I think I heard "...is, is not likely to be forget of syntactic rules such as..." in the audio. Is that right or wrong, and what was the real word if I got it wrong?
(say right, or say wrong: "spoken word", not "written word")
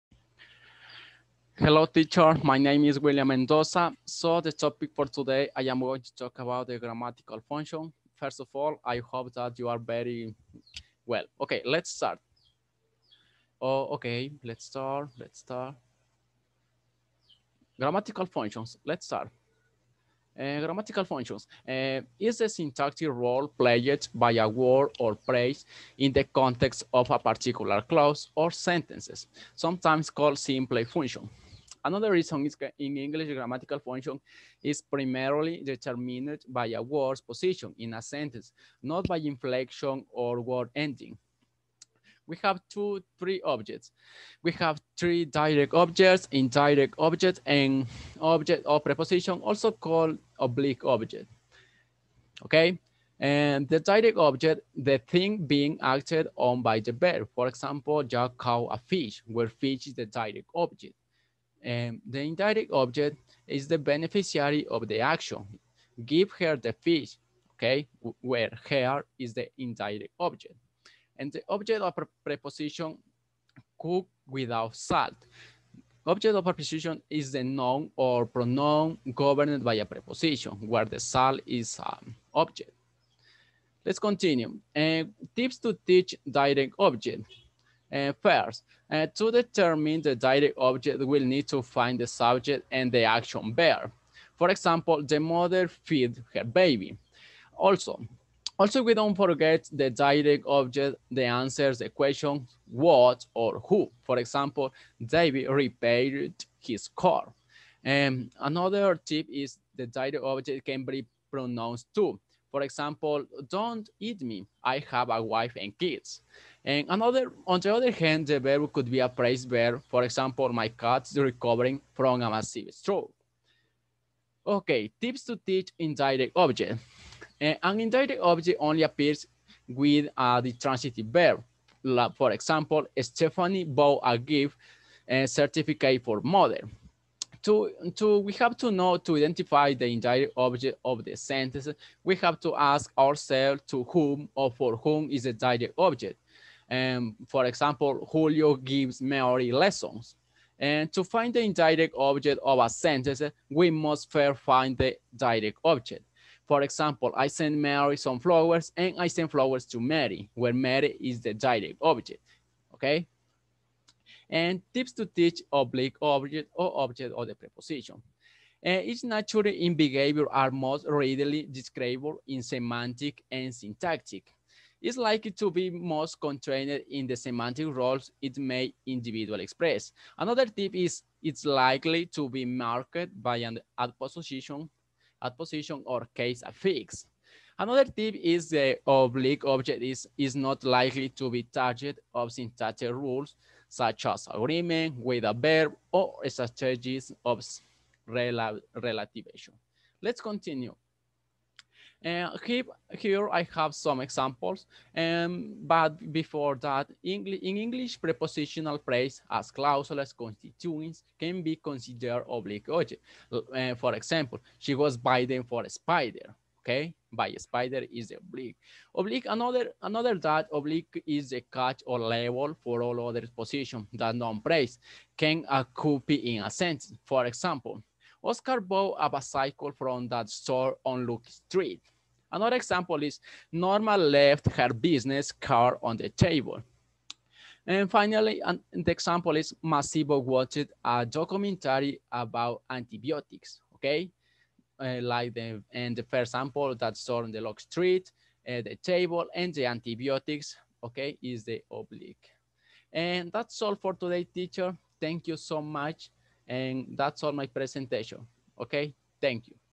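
wrong: "target", not "forget".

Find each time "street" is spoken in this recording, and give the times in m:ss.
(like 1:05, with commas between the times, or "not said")
3:51, 4:07.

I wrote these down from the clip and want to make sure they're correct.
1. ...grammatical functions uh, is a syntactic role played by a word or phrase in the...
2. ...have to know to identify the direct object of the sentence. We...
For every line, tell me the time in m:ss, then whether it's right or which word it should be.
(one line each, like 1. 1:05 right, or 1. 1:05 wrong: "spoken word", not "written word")
1. 0:20 right
2. 2:18 wrong: "indirect", not "direct".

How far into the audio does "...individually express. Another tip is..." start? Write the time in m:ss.
2:58.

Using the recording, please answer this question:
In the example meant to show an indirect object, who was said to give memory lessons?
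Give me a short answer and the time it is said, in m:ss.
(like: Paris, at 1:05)
Julio, at 2:28.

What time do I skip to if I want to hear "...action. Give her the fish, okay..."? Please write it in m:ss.
1:04.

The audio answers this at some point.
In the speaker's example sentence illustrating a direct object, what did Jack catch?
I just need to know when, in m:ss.
0:58.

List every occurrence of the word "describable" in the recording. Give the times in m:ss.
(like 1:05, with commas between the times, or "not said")
2:51.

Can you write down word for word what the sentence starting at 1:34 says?
For example, the mother feed her baby.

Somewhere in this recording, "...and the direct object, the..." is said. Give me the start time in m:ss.
0:53.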